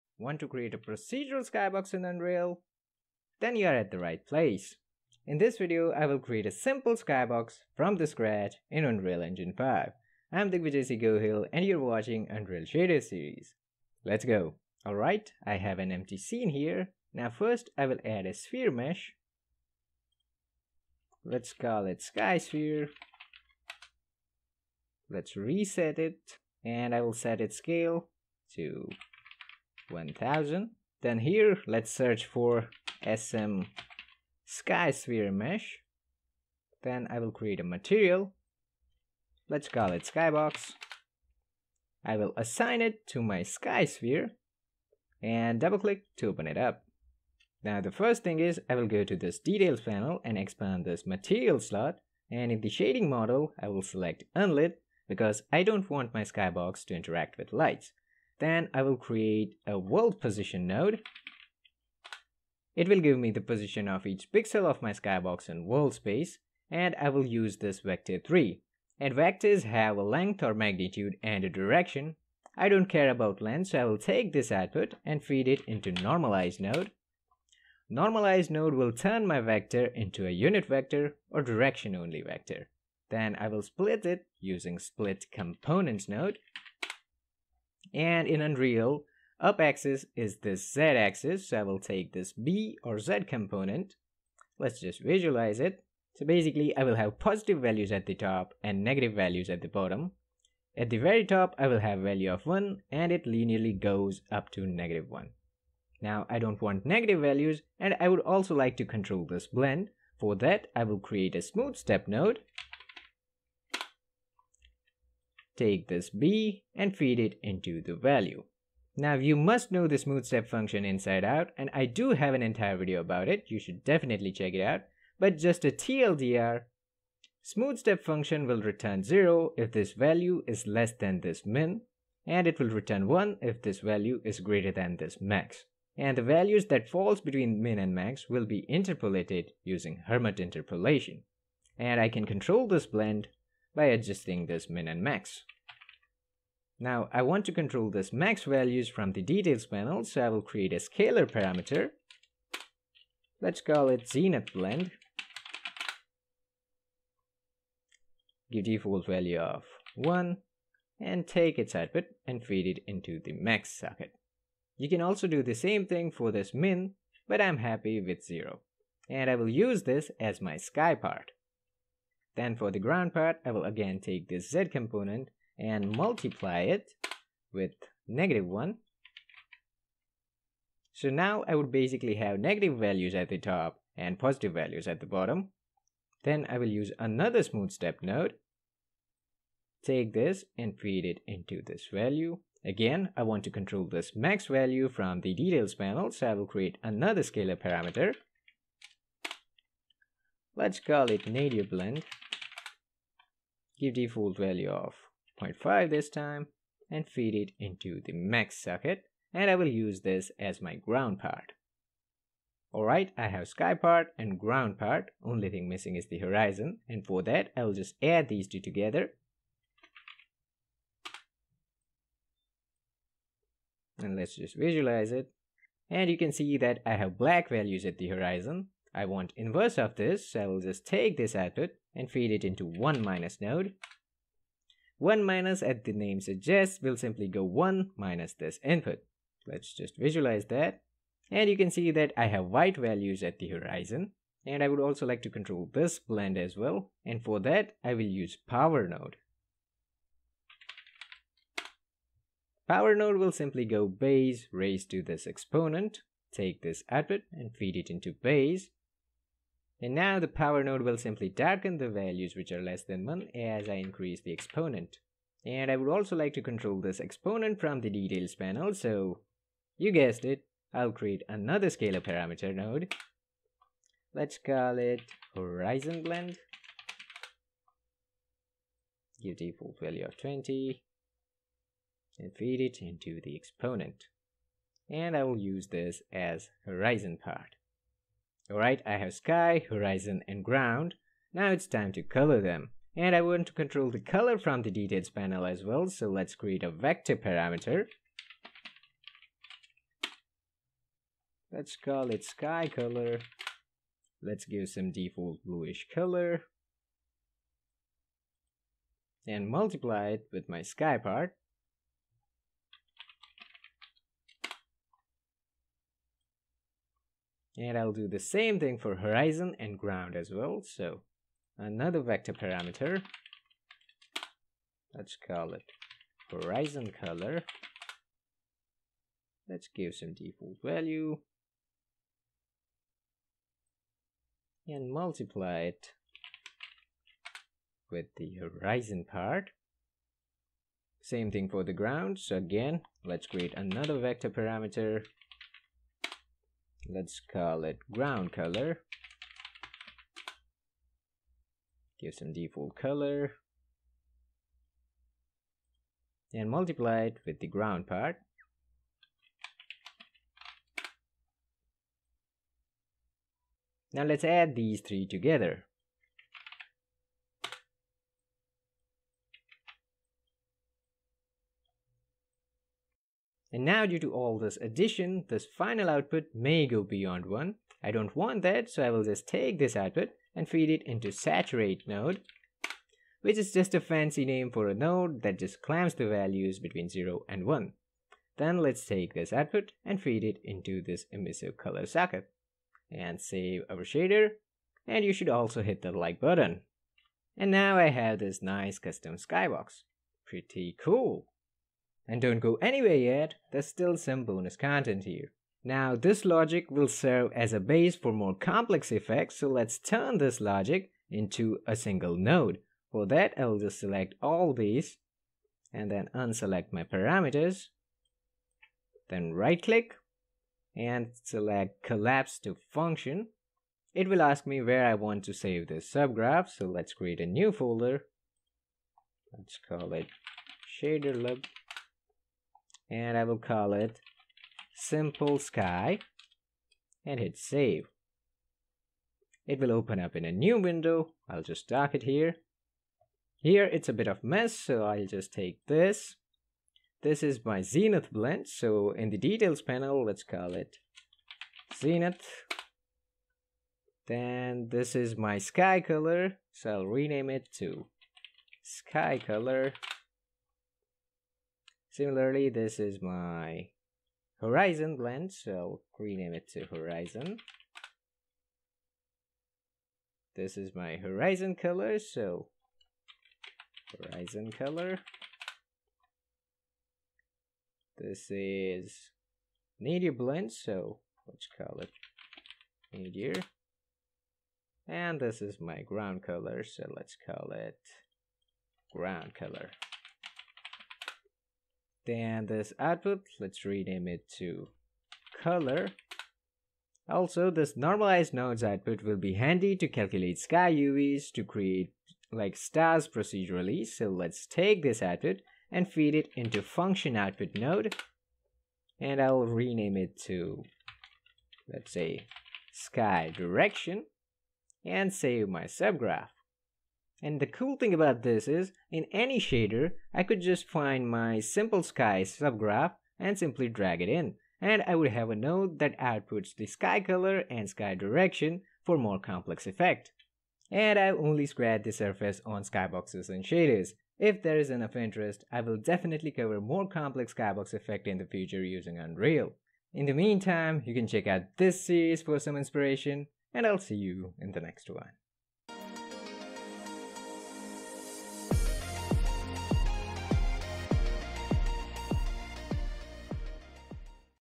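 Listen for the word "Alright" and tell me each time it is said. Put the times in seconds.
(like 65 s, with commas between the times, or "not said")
14 s, 212 s, 288 s.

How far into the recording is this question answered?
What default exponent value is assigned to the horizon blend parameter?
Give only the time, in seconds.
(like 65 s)
280 s.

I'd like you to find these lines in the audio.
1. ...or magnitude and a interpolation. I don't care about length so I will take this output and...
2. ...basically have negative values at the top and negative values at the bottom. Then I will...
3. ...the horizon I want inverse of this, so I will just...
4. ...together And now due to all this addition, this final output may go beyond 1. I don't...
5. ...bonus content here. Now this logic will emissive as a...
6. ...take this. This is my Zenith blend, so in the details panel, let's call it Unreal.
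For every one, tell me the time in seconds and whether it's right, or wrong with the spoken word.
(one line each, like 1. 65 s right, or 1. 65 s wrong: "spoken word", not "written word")
1. 70 s wrong: "direction", not "interpolation"
2. 181 s wrong: "positive", not "negative"
3. 227 s right
4. 365 s right
5. 404 s wrong: "serve", not "emissive"
6. 445 s wrong: "Zenith", not "Unreal".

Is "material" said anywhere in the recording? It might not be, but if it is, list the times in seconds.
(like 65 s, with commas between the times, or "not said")
37 s, 51 s.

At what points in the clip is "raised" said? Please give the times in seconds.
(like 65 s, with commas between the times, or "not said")
254 s.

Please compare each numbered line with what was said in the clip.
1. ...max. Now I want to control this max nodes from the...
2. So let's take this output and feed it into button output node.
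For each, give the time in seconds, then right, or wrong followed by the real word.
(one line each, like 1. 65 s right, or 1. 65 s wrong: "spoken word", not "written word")
1. 145 s wrong: "values", not "nodes"
2. 503 s wrong: "function", not "button".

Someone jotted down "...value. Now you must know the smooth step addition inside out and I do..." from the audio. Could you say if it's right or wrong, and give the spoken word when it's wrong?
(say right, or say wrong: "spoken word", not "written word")
wrong: "function", not "addition".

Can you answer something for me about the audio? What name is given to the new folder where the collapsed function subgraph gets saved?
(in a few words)
shaderlib.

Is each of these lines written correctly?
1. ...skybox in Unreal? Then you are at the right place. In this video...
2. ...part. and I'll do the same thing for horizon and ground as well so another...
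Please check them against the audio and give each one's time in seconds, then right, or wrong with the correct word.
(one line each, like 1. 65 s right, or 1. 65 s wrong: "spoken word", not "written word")
1. 1 s right
2. 310 s right.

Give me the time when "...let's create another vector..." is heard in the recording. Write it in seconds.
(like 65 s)
343 s.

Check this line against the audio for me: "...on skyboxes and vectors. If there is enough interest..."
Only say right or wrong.
wrong.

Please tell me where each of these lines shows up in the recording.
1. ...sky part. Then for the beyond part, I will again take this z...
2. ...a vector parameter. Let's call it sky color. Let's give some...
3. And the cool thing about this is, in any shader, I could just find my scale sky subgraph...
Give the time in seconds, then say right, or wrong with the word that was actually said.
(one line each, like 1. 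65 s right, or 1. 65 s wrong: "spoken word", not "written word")
1. 170 s wrong: "ground", not "beyond"
2. 296 s right
3. 517 s wrong: "simple", not "scale".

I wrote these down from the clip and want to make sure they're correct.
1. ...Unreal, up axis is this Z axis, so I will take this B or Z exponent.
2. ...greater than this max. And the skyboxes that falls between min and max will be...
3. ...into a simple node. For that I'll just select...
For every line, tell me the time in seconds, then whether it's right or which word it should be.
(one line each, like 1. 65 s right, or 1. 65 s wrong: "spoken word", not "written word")
1. 88 s wrong: "component", not "exponent"
2. 134 s wrong: "values", not "skyboxes"
3. 411 s wrong: "single", not "simple".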